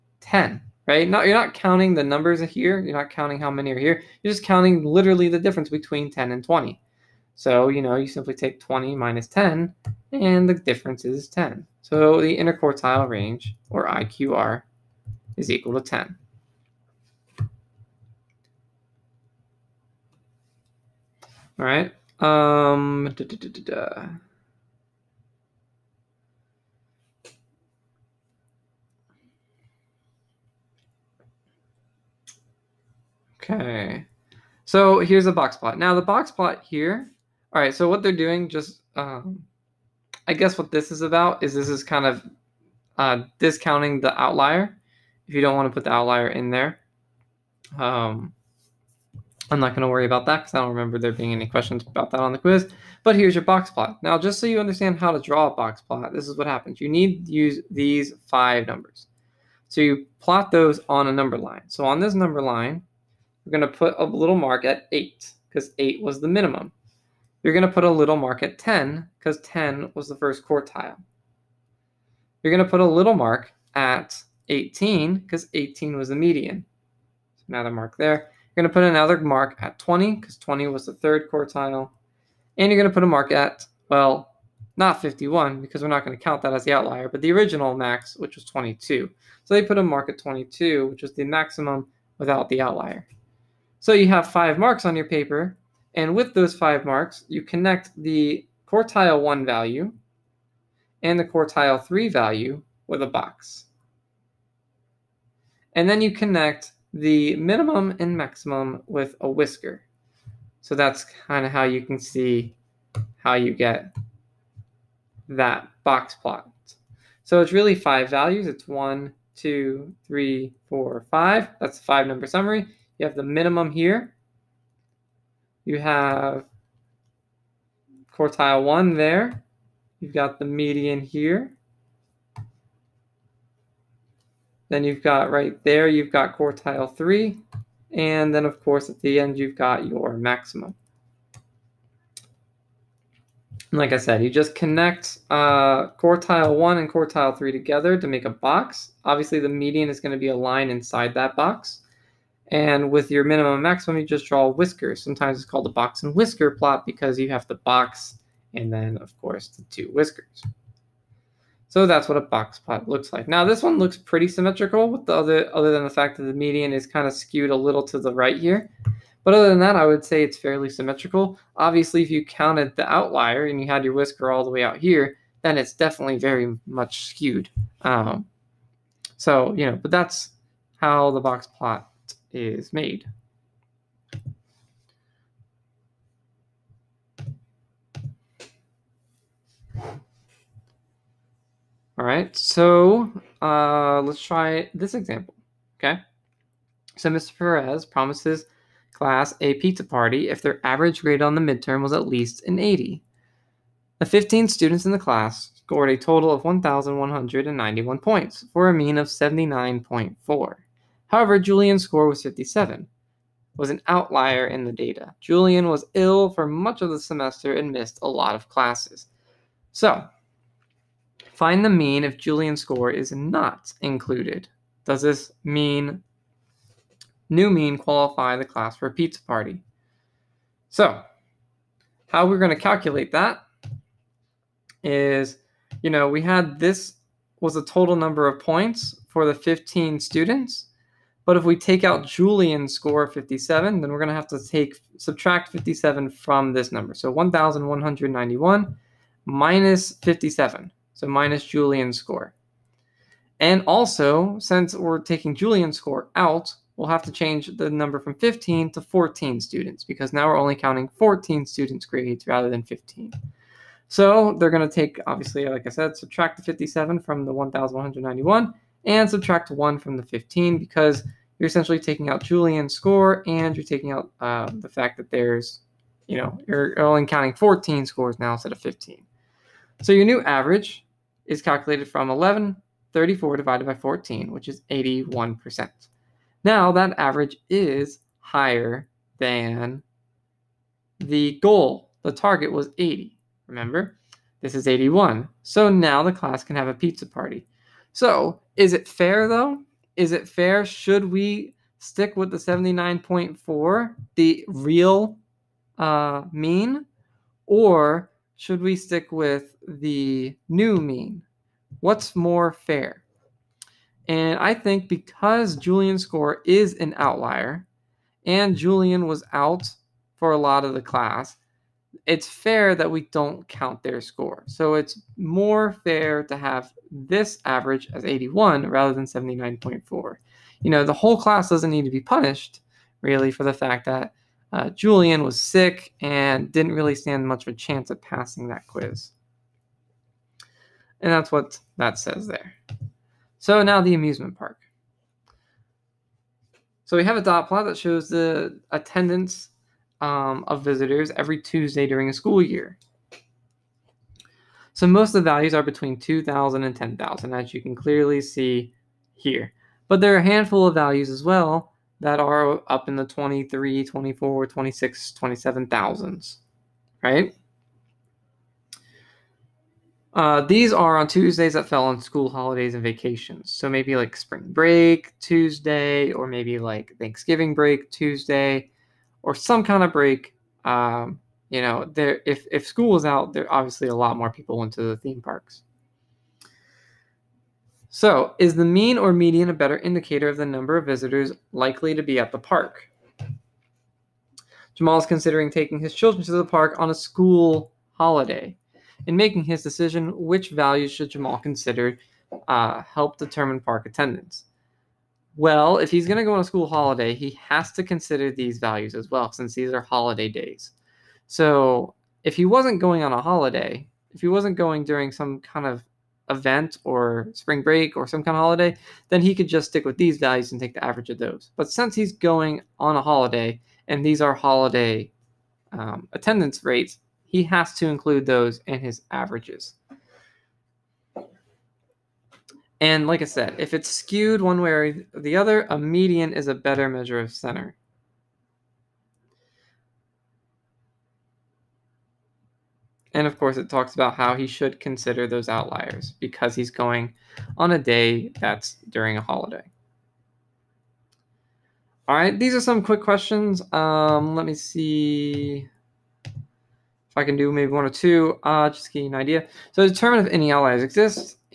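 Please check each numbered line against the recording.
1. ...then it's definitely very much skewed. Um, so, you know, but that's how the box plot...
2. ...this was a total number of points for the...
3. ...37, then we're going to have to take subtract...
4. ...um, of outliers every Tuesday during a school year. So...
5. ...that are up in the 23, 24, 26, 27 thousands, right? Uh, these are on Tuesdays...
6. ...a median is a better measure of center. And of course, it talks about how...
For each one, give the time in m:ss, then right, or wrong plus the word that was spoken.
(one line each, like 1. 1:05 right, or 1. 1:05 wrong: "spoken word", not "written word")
1. 2:55 right
2. 3:56 right
3. 4:03 wrong: "57", not "37"
4. 5:49 wrong: "visitors", not "outliers"
5. 6:01 right
6. 7:15 right.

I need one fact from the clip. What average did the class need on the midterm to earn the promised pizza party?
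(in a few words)
80.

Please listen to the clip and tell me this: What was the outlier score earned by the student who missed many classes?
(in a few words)
57.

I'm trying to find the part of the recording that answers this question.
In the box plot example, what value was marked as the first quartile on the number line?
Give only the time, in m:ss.
1:09.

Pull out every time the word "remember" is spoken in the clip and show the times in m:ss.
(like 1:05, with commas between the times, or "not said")
0:50, 4:53.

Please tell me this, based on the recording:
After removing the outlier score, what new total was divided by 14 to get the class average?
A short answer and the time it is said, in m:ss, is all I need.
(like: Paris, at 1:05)
1134, at 4:42.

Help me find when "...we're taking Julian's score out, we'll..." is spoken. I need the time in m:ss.
4:14.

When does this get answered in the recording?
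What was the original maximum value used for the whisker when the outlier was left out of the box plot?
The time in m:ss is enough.
1:27.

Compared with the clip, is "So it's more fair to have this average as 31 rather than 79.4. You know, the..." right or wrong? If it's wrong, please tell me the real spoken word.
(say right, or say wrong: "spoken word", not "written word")
wrong: "81", not "31".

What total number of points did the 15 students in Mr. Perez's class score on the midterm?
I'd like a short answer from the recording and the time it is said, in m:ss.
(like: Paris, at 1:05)
1,191, at 3:25.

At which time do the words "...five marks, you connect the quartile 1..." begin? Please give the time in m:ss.
1:36.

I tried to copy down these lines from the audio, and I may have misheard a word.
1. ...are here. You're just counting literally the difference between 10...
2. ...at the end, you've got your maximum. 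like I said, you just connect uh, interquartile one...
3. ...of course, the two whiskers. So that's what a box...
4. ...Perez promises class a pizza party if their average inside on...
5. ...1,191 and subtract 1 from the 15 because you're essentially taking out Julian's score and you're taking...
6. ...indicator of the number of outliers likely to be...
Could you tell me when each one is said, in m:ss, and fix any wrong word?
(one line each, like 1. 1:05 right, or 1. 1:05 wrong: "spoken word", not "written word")
1. 0:03 right
2. 2:18 wrong: "quartile", not "interquartile"
3. 2:38 right
4. 3:17 wrong: "grade", not "inside"
5. 4:27 right
6. 6:29 wrong: "visitors", not "outliers".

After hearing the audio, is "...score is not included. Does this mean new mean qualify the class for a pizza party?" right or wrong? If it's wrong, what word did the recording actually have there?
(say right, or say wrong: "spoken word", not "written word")
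right.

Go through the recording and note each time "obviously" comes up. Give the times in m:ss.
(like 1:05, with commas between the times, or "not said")
2:29, 2:51, 4:25, 6:23.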